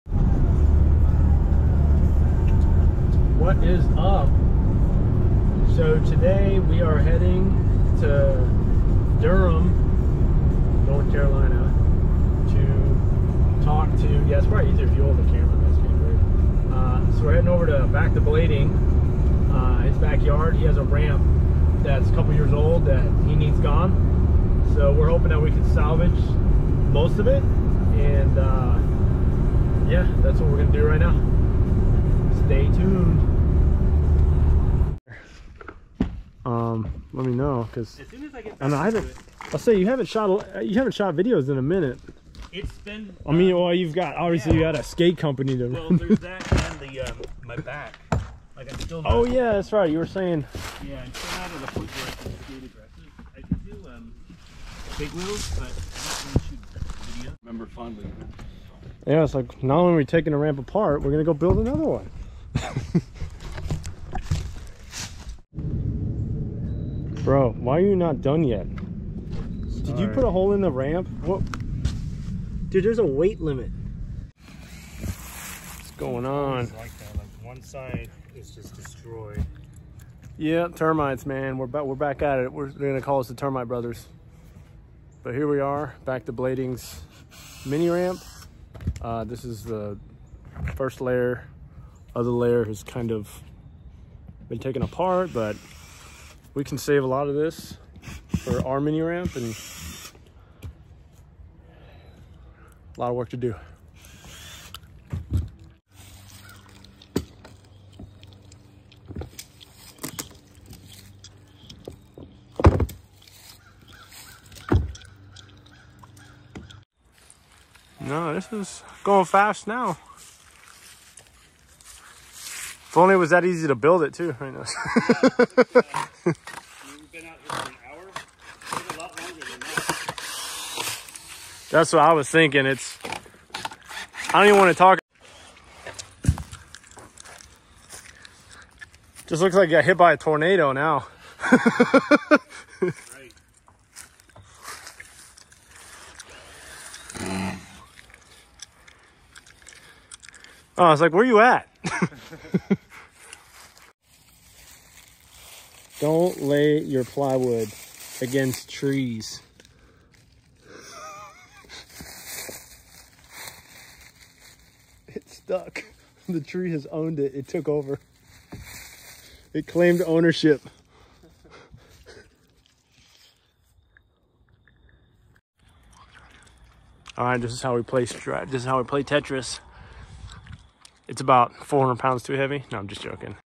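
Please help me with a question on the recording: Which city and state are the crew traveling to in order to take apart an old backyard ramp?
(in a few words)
Durham, North Carolina.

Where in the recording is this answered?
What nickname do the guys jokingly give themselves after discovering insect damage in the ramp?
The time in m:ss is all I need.
1:23.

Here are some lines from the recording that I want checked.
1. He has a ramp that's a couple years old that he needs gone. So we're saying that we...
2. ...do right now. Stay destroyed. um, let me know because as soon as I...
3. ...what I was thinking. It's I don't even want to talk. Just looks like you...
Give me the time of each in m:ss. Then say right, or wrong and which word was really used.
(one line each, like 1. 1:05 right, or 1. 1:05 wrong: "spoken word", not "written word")
1. 0:20 wrong: "hoping", not "saying"
2. 0:30 wrong: "tuned", not "destroyed"
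3. 2:11 right.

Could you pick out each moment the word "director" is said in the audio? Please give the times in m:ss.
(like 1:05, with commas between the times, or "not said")
not said.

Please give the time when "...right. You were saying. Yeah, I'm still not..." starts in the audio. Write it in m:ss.
0:49.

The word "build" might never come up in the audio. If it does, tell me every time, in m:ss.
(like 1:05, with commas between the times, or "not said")
1:01, 2:03.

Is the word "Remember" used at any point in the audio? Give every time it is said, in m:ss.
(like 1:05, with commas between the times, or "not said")
0:57.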